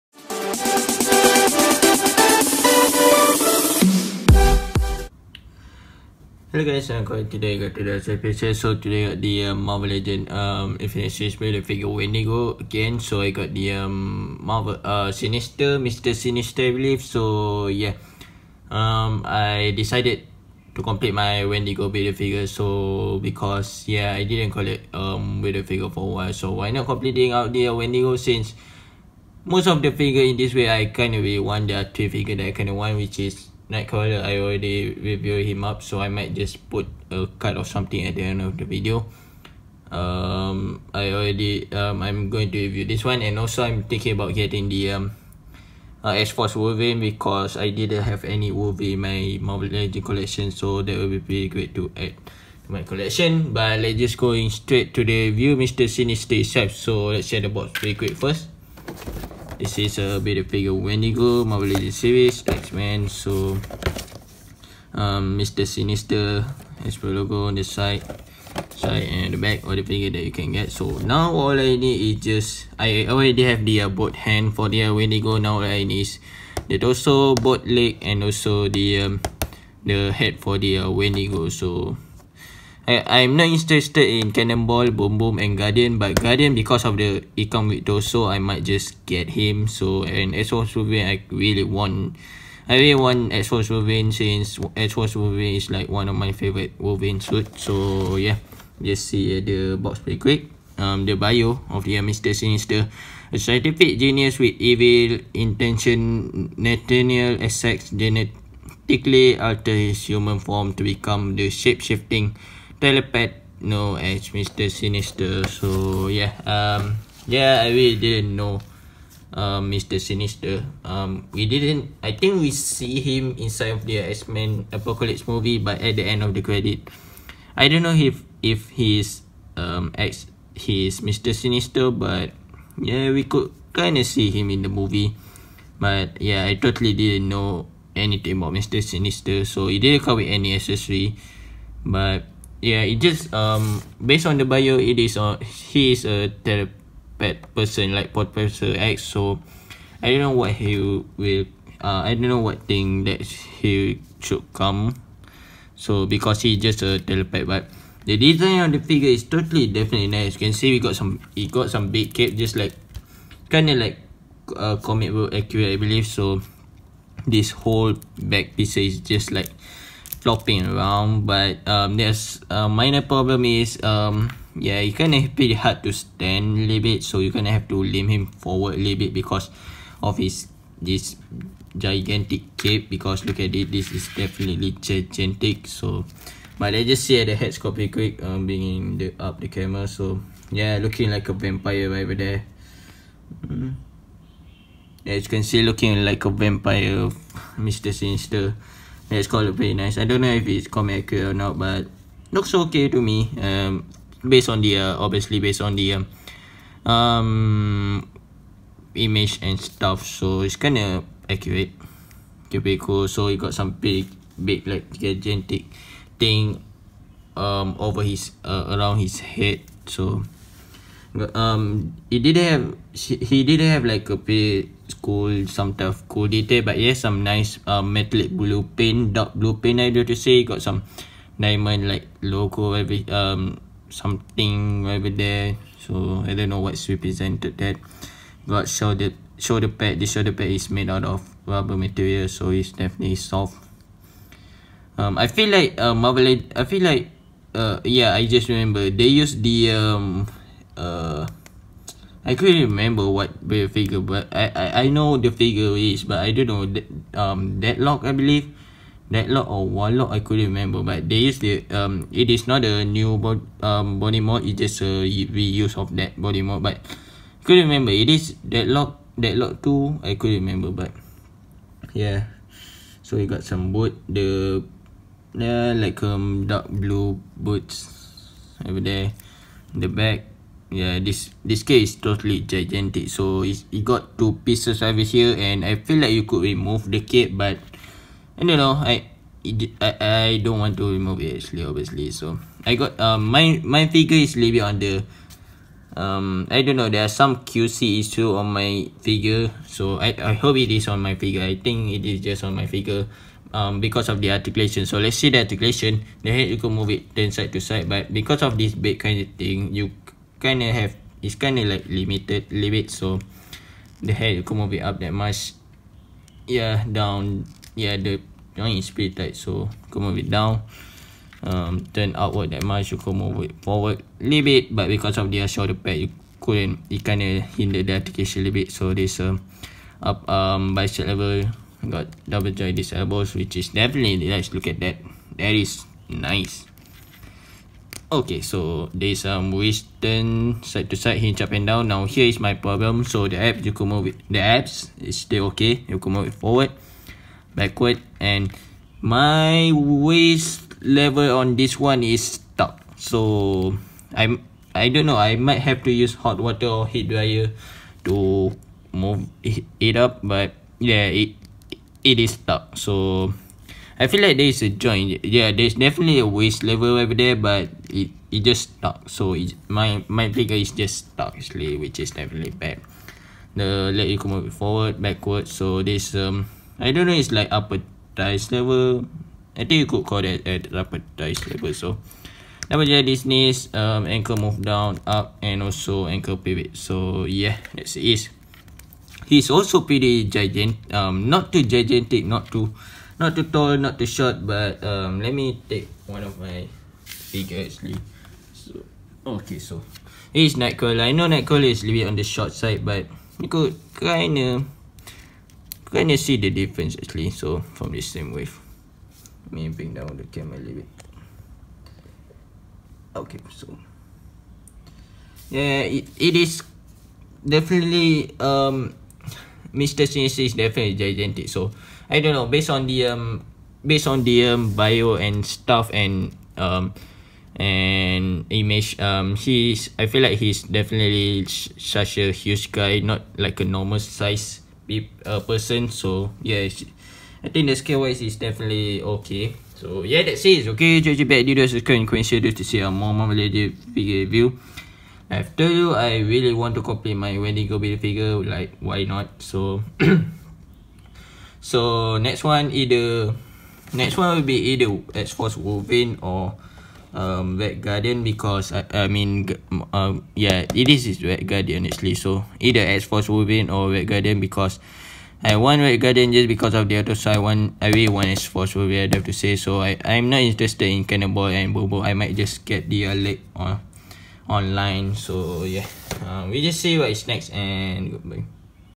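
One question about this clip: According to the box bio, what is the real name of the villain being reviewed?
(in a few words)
Nathaniel Essex.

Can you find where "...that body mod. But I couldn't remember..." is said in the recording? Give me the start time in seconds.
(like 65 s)
265 s.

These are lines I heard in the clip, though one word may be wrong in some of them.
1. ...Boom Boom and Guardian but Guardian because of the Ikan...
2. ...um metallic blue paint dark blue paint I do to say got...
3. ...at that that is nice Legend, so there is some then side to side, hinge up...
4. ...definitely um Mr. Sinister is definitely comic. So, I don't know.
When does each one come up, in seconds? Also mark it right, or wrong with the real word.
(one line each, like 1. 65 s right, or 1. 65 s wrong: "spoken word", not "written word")
1. 84 s right
2. 227 s right
3. 334 s wrong: "Okay", not "Legend"
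4. 417 s wrong: "gigantic", not "comic".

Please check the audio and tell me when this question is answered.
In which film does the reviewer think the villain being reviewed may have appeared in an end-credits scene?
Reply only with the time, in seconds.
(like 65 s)
124 s.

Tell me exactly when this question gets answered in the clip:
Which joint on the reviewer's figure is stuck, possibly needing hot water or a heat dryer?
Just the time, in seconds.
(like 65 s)
349 s.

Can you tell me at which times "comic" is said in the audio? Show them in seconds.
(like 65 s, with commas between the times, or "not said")
164 s, 200 s.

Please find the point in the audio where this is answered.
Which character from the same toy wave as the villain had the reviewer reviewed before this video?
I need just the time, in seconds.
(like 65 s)
33 s.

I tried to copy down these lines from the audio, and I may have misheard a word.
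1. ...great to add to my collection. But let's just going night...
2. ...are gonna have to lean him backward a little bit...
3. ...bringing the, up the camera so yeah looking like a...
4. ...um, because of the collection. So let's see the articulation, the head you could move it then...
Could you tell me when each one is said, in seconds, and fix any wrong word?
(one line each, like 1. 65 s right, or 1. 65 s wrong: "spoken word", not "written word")
1. 51 s wrong: "straight", not "night"
2. 177 s wrong: "forward", not "backward"
3. 188 s right
4. 303 s wrong: "articulation", not "collection".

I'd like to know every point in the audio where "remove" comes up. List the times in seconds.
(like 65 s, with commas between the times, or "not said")
286 s, 290 s.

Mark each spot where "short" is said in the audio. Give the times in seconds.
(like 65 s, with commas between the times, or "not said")
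394 s, 402 s.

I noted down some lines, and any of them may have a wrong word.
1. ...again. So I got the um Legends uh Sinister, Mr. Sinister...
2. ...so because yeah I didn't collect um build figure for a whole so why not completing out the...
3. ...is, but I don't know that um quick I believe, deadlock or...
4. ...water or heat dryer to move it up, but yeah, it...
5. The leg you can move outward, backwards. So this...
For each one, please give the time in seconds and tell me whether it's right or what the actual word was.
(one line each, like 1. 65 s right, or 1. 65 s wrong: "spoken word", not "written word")
1. 12 s wrong: "Marvel", not "Legends"
2. 22 s wrong: "while", not "whole"
3. 255 s wrong: "deadlock", not "quick"
4. 356 s right
5. 373 s wrong: "forward", not "outward".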